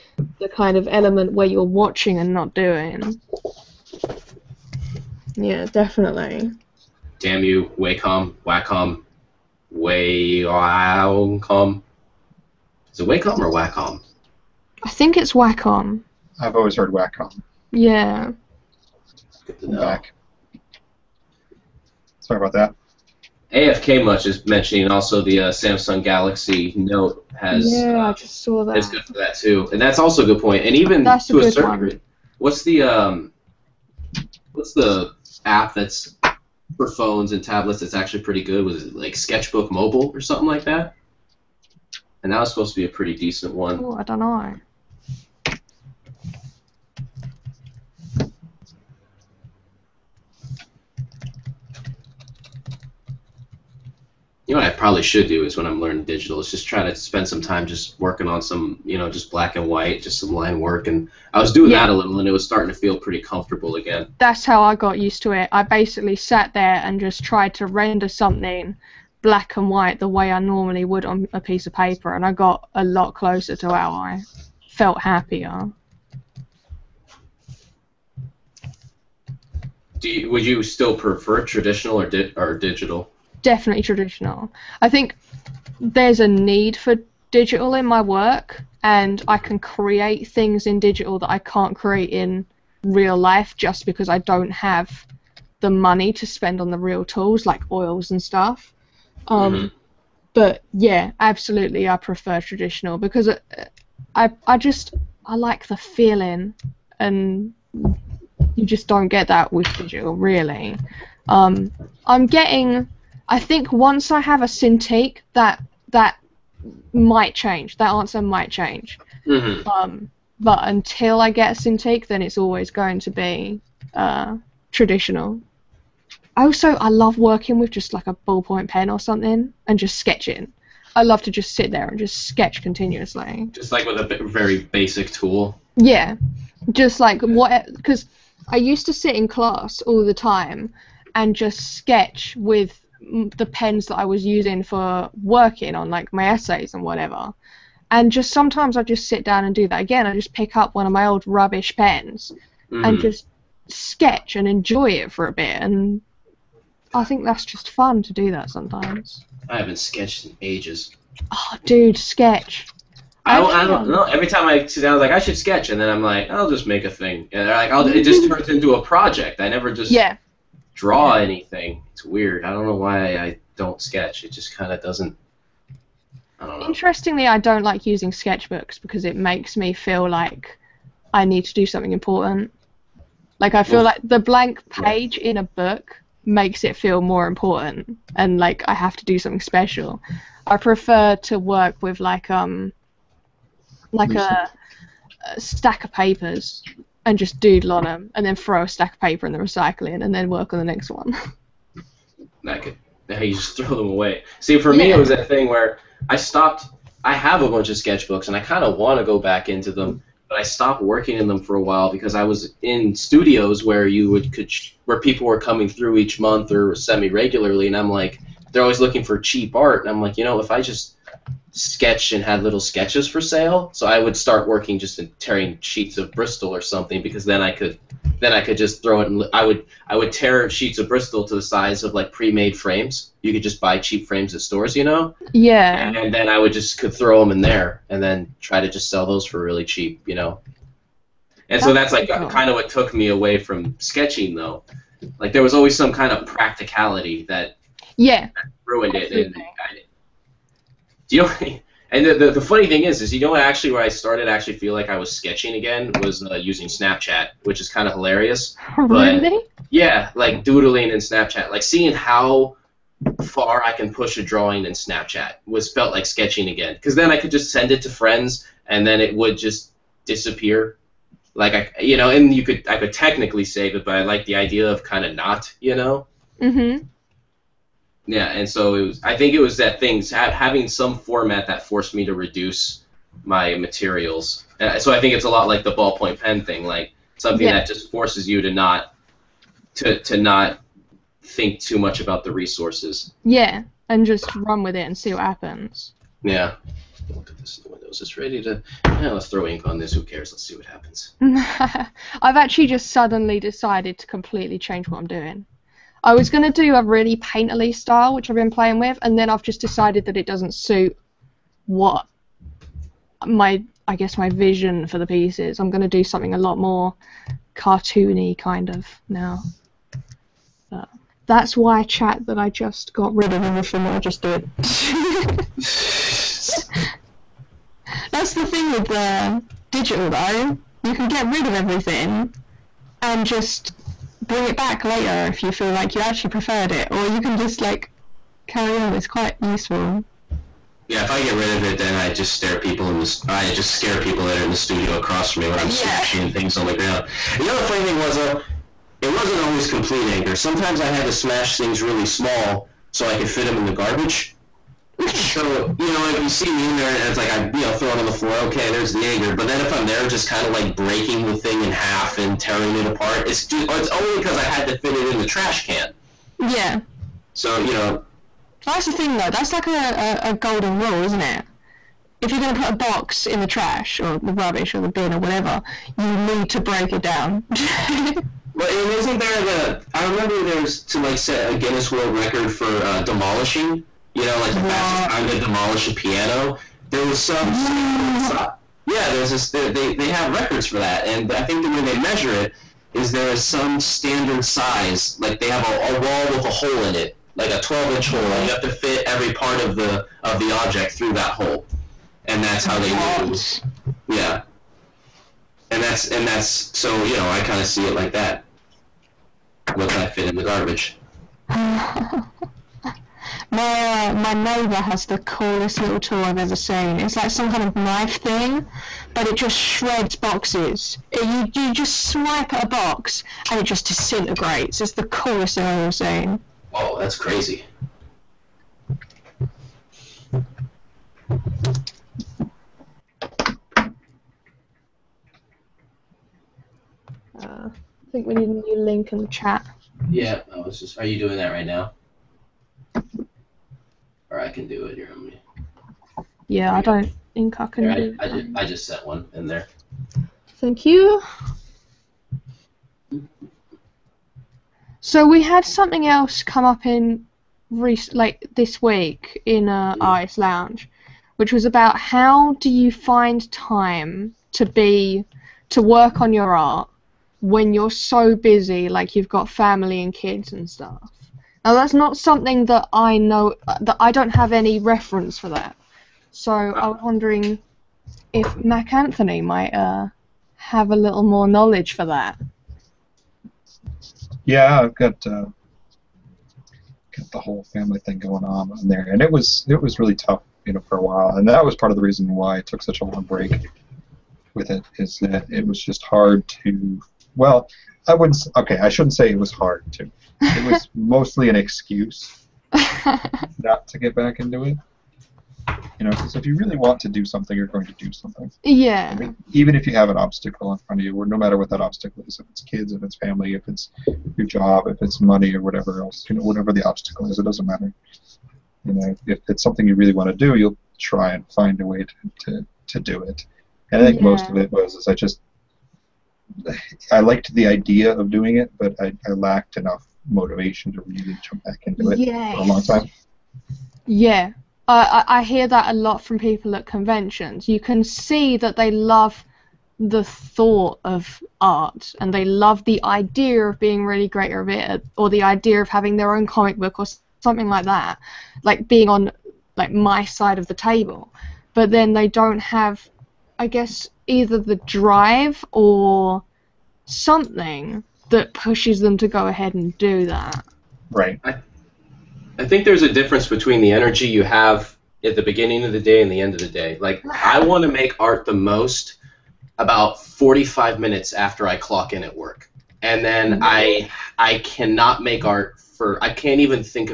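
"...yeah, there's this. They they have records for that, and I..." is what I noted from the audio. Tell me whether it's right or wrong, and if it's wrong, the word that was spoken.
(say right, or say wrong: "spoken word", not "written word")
right.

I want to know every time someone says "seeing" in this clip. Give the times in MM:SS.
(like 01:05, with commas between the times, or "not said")
04:21.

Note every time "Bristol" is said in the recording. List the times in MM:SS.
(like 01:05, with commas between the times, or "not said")
03:46, 03:50.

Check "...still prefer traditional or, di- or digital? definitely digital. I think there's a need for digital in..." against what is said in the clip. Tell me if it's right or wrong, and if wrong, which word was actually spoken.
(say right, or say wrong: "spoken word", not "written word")
wrong: "traditional", not "digital".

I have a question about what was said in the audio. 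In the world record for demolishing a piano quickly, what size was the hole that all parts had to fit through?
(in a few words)
12-inch.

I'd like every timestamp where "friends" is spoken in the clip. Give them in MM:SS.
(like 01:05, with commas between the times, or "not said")
04:27.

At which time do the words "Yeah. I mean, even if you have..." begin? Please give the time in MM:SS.
08:28.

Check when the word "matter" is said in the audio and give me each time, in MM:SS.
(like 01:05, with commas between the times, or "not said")
08:31, 08:37.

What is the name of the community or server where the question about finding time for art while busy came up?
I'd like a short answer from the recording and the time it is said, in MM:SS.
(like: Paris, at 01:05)
ice Lounge, at 07:40.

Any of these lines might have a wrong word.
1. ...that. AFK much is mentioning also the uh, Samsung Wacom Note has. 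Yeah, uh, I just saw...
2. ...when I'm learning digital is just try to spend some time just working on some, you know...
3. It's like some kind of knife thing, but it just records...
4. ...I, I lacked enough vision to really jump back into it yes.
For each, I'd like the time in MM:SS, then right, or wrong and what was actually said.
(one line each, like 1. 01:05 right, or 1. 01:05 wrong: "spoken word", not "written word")
1. 00:22 wrong: "Galaxy", not "Wacom"
2. 00:55 right
3. 06:56 wrong: "shreds", not "records"
4. 08:48 wrong: "motivation", not "vision".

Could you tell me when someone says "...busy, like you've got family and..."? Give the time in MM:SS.
07:48.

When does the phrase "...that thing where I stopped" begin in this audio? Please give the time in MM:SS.
03:25.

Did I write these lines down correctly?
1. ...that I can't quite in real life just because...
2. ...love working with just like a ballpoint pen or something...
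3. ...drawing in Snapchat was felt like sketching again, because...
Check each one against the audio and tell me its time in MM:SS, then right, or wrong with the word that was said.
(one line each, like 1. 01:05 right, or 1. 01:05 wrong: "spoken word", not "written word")
1. 01:31 wrong: "create", not "quite"
2. 02:06 right
3. 04:24 right.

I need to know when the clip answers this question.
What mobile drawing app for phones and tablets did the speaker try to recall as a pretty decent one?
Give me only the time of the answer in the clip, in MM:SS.
00:39.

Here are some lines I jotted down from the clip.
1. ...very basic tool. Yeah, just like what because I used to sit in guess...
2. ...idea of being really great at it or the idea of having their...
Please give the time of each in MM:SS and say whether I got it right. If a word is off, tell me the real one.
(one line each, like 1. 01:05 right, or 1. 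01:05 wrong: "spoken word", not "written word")
1. 02:14 wrong: "class", not "guess"
2. 09:03 right.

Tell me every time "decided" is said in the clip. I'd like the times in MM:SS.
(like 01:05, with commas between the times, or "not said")
05:03, 05:09.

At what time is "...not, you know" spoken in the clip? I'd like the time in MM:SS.
04:35.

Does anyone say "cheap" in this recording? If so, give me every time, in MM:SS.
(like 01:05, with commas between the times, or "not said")
03:39, 03:53, 03:59.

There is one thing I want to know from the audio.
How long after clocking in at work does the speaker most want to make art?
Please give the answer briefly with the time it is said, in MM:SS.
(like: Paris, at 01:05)
45, at 09:30.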